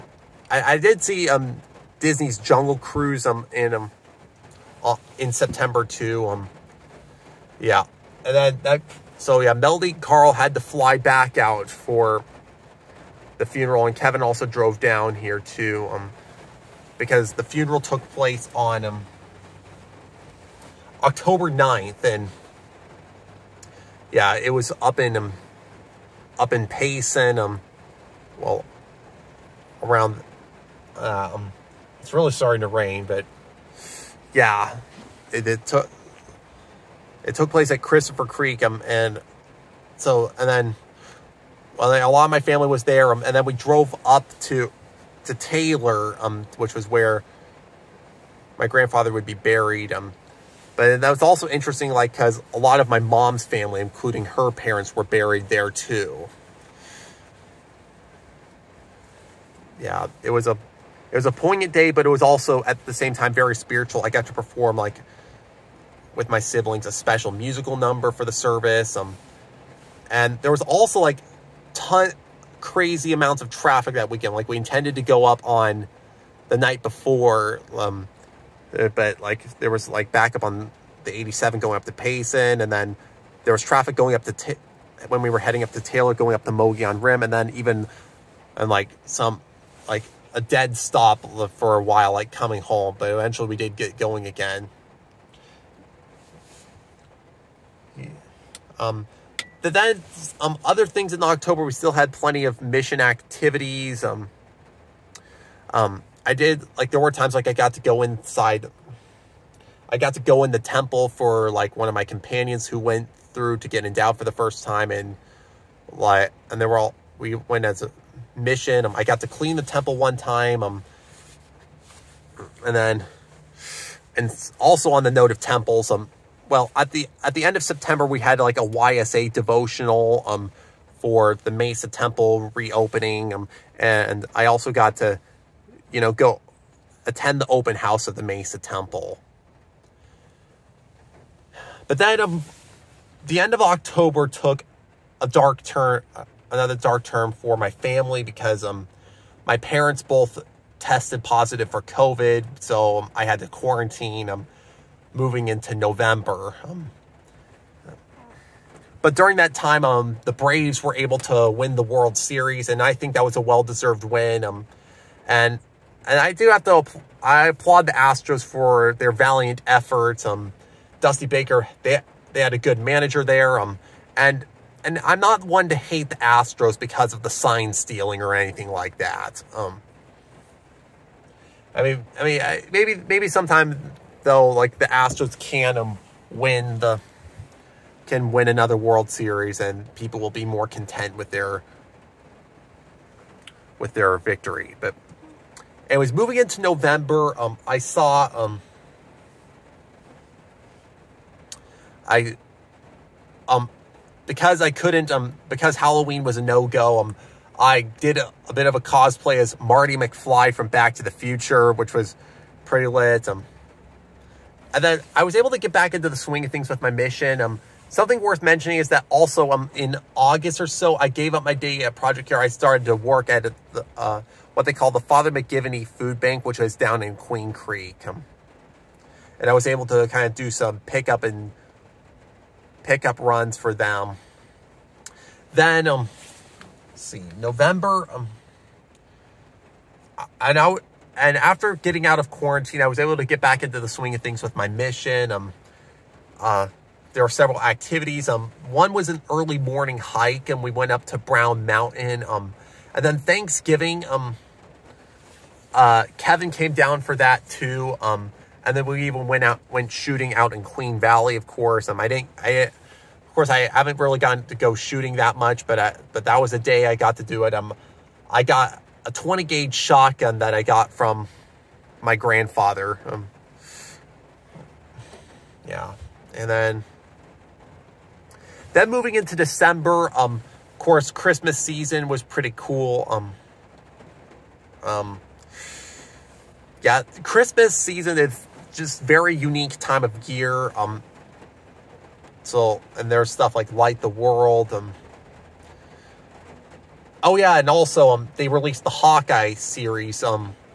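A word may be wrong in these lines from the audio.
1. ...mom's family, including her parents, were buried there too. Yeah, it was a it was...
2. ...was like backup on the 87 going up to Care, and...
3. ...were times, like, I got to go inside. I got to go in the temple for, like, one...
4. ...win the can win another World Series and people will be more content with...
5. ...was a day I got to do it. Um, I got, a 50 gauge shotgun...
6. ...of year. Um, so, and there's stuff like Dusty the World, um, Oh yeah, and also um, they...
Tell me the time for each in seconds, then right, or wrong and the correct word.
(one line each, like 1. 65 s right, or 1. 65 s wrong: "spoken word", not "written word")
1. 52 s right
2. 79 s wrong: "Payson", not "Care"
3. 107 s right
4. 186 s right
5. 266 s wrong: "20", not "50"
6. 290 s wrong: "Light", not "Dusty".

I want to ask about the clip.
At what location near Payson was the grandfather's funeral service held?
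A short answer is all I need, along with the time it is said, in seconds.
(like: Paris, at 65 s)
Christopher Creek, at 37 s.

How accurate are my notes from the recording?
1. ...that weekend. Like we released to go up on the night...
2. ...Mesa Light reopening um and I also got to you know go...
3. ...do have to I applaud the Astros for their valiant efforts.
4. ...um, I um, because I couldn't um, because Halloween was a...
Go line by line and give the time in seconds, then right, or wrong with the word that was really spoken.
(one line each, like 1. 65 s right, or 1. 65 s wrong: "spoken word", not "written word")
1. 73 s wrong: "intended", not "released"
2. 131 s wrong: "Temple", not "Light"
3. 166 s right
4. 198 s right.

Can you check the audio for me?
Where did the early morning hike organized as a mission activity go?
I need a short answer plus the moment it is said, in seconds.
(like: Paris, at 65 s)
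Brown Mountain, at 251 s.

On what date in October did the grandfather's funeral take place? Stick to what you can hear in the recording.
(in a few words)
October 9.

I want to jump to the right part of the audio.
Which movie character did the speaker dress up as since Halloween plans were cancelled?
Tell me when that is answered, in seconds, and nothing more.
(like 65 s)
209 s.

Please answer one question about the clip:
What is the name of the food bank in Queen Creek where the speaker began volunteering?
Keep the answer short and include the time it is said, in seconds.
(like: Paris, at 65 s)
Father McGivney Food Bank, at 224 s.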